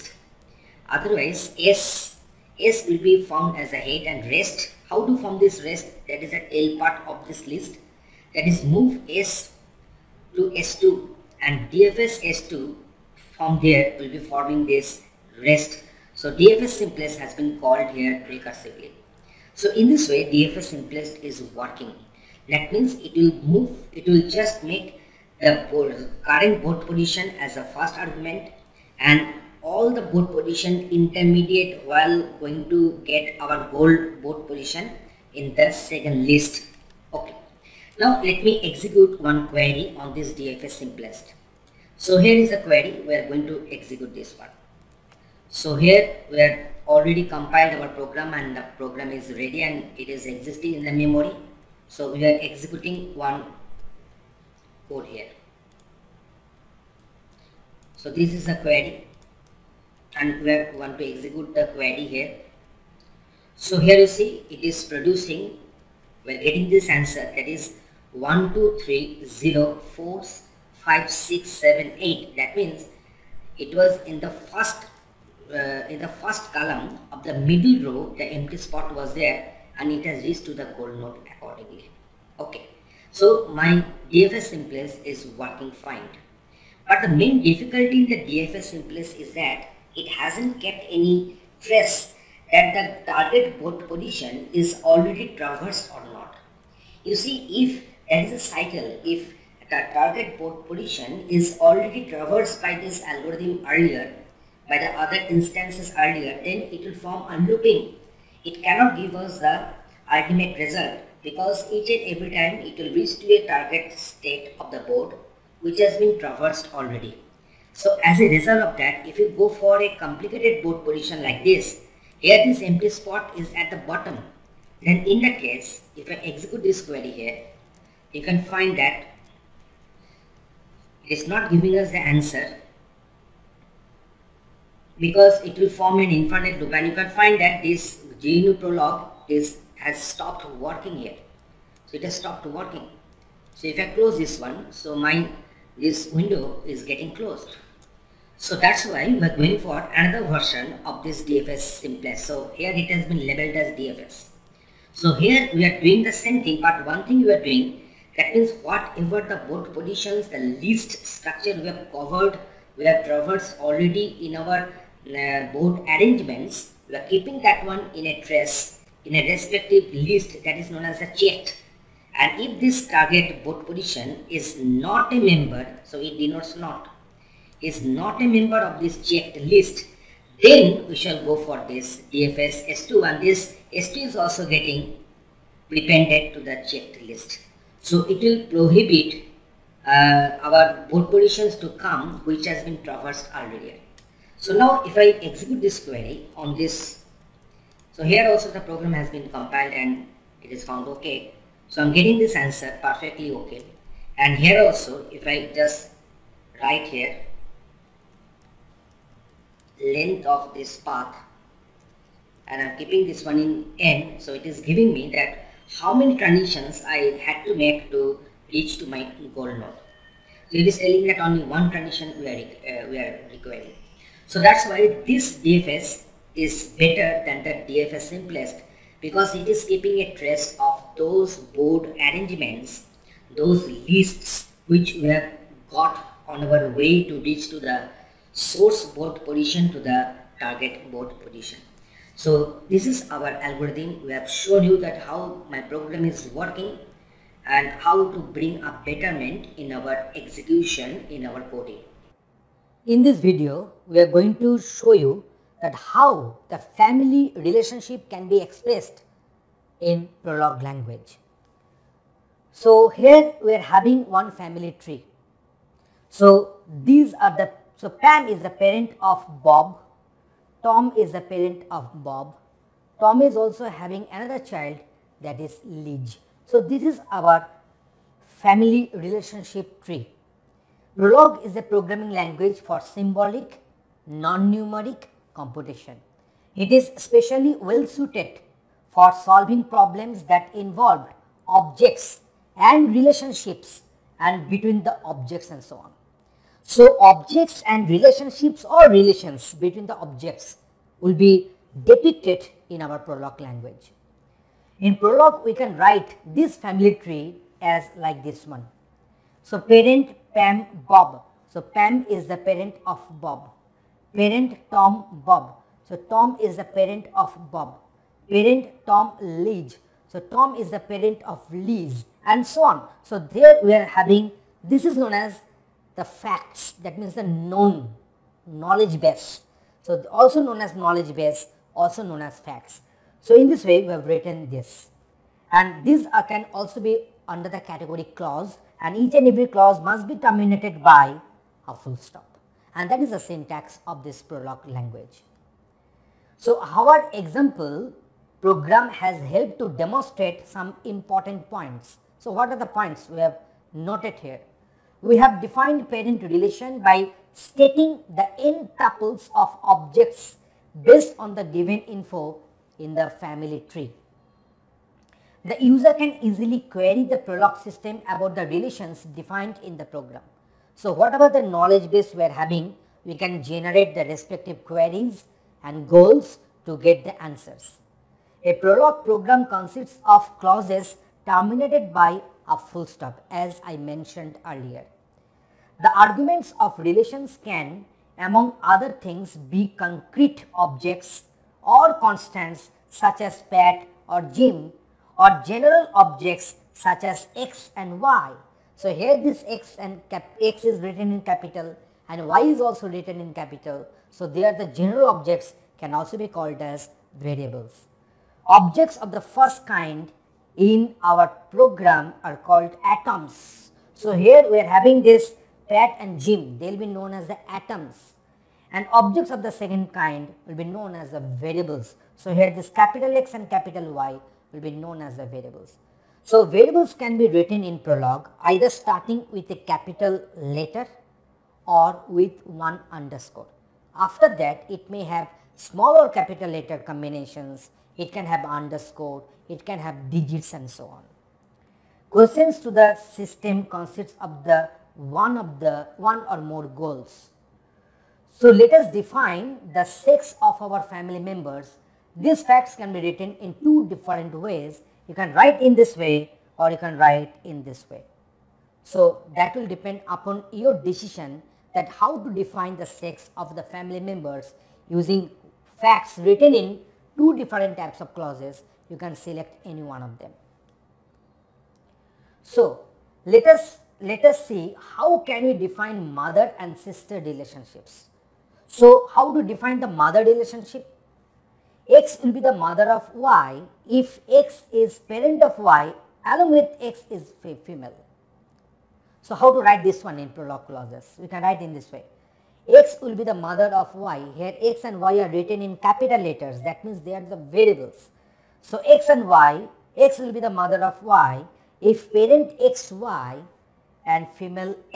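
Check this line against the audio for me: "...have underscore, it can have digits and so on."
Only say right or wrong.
right.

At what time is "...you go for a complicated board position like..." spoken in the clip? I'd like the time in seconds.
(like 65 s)
119 s.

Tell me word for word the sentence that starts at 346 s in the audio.
So our example program has helped to demonstrate some important points.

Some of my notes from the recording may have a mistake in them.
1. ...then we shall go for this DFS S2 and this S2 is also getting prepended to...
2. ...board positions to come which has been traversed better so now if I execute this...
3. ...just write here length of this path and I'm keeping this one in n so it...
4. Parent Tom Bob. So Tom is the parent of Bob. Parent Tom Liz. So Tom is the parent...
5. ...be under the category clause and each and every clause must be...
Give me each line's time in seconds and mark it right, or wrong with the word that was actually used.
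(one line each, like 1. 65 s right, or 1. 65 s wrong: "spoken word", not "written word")
1. 180 s right
2. 190 s wrong: "earlier", not "better"
3. 205 s right
4. 314 s right
5. 336 s right.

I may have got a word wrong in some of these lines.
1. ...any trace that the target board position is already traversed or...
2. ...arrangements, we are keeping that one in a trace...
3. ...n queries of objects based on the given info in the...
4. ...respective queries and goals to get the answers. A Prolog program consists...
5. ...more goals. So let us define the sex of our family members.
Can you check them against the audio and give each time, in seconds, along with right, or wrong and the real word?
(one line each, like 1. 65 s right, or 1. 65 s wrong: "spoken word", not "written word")
1. 90 s right
2. 165 s right
3. 358 s wrong: "tuples", not "queries"
4. 374 s right
5. 446 s right.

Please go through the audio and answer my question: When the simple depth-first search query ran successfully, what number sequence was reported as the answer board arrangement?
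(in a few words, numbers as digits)
1 2 3 0 4 5 6 7 8.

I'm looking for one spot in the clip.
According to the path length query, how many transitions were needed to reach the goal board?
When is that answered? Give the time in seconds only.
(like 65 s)
221 s.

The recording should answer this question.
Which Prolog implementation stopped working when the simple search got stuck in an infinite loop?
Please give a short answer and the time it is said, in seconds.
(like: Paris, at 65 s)
GNU Prolog, at 138 s.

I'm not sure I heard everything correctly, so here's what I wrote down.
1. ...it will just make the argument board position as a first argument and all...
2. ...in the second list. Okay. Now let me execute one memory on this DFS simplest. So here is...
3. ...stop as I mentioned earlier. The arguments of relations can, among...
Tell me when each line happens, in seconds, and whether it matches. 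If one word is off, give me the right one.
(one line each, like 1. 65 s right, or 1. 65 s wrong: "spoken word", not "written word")
1. 23 s wrong: "current", not "argument"
2. 35 s wrong: "query", not "memory"
3. 382 s right.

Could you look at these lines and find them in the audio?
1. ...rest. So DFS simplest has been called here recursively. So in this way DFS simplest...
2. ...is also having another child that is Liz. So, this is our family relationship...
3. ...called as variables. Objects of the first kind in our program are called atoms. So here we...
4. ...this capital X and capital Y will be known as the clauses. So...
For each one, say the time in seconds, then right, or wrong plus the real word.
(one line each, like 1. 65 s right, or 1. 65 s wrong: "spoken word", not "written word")
1. 15 s right
2. 273 s right
3. 406 s right
4. 422 s wrong: "variables", not "clauses".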